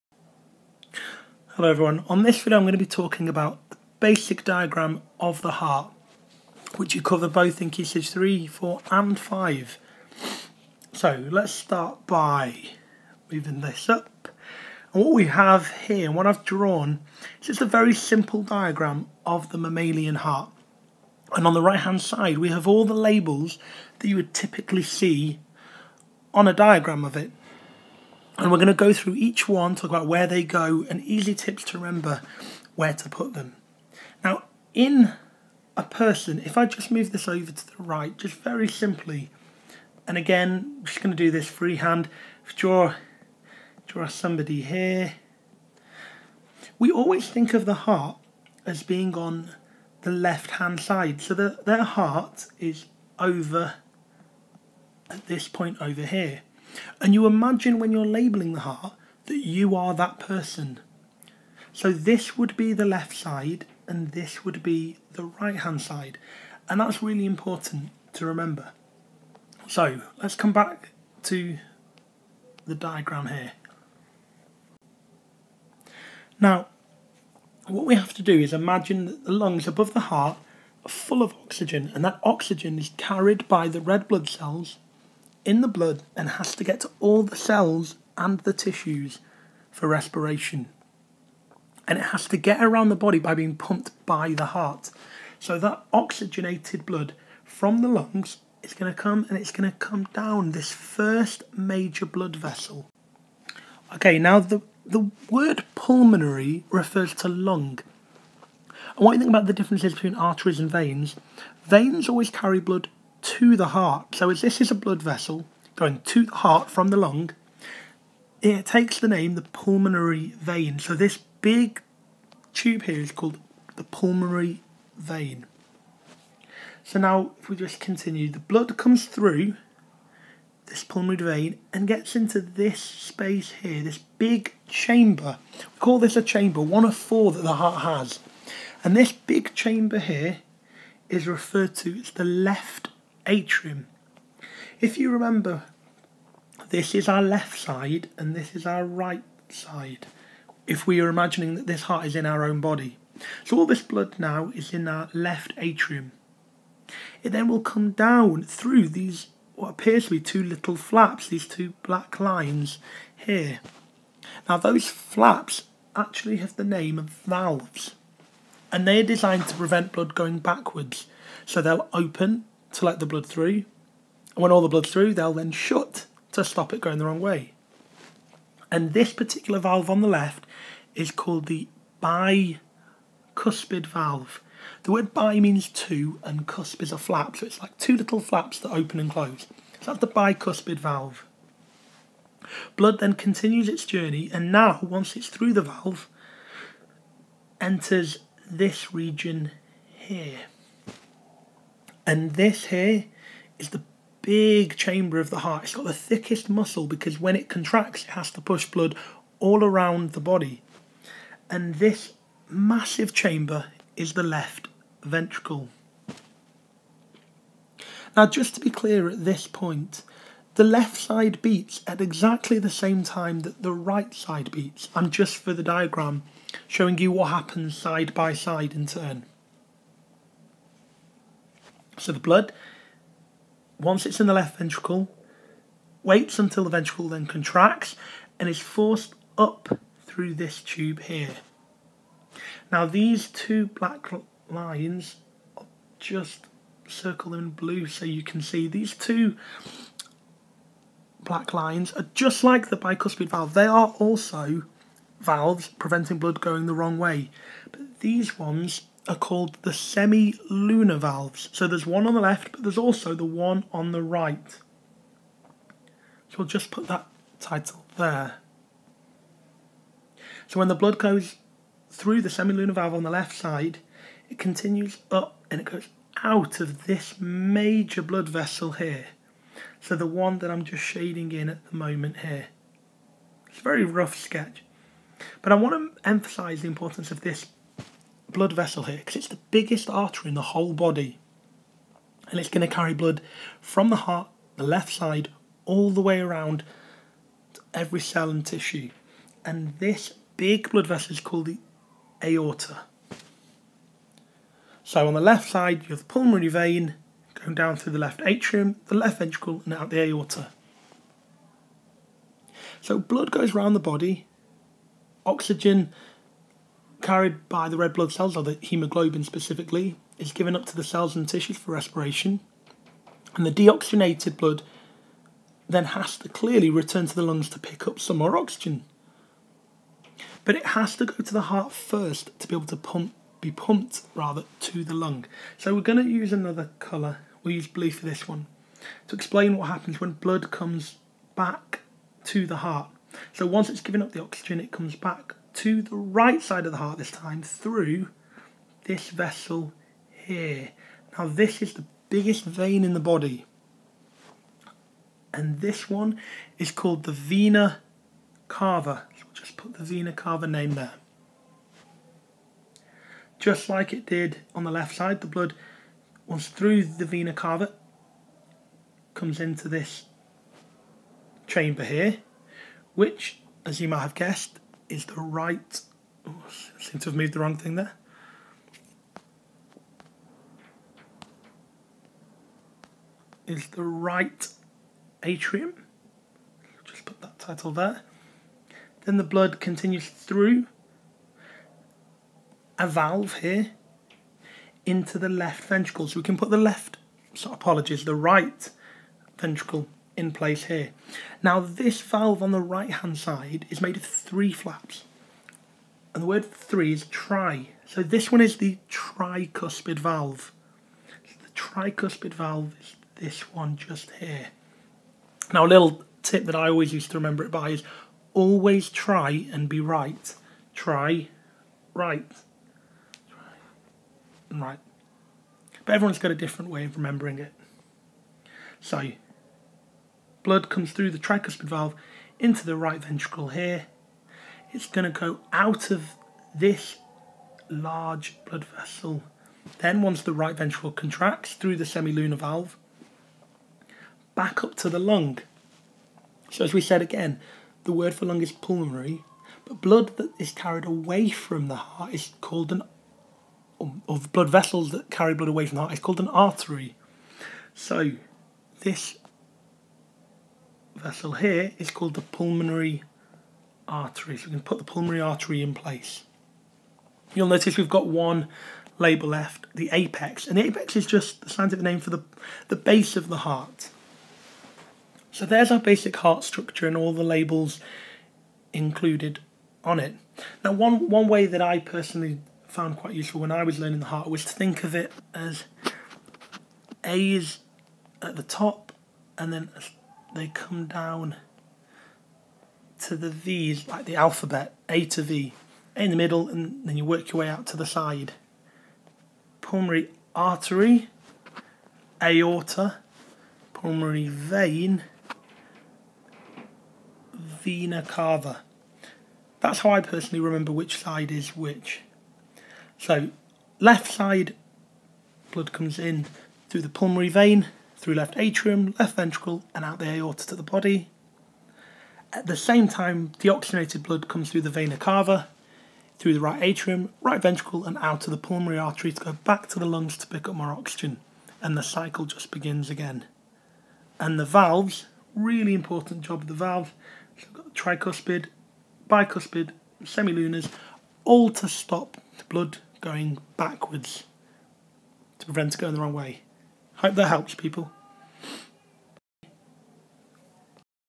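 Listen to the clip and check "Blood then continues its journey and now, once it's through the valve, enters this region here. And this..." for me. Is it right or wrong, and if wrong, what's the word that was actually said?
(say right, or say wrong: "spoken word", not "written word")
right.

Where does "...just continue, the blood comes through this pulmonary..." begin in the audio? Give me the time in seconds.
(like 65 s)
127 s.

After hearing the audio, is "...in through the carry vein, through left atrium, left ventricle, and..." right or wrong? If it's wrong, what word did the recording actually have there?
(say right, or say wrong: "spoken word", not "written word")
wrong: "pulmonary", not "carry".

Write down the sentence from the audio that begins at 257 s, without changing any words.
But these ones are called the semi-lunar valves.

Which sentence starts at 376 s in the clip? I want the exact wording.
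Oh, seem to have moved the wrong thing there.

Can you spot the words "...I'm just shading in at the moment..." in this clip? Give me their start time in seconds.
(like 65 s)
280 s.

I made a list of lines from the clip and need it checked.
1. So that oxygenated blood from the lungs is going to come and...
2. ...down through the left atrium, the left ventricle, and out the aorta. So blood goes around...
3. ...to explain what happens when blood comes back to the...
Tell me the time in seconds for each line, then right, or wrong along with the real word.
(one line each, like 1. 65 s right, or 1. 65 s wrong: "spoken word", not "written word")
1. 95 s right
2. 307 s right
3. 339 s right.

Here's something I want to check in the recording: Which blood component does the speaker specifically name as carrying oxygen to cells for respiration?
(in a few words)
hemoglobin.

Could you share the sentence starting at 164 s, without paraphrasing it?
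Now those flaps actually have the name of valves and they are designed to prevent blood going backwards.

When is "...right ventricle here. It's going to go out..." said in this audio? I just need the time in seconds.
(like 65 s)
432 s.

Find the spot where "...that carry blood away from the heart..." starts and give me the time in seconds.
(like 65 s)
454 s.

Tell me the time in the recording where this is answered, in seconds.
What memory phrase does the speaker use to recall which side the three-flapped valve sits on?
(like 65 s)
418 s.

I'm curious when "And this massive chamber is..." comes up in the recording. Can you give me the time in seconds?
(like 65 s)
211 s.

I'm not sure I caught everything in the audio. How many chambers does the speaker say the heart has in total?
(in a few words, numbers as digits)
4.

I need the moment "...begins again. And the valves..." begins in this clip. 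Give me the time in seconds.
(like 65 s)
532 s.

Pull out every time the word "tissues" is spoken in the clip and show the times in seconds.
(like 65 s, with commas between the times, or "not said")
88 s, 298 s, 321 s.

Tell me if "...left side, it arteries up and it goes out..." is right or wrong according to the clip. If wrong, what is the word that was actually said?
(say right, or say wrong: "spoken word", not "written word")
wrong: "continues", not "arteries".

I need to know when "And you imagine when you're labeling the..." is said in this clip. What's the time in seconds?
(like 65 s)
56 s.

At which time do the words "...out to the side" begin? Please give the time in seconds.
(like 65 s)
497 s.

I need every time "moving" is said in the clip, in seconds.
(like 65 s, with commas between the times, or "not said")
13 s.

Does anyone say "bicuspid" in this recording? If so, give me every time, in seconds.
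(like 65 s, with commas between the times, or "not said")
182 s, 190 s, 252 s, 539 s.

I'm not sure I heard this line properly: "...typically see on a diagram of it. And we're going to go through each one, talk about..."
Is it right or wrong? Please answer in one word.
right.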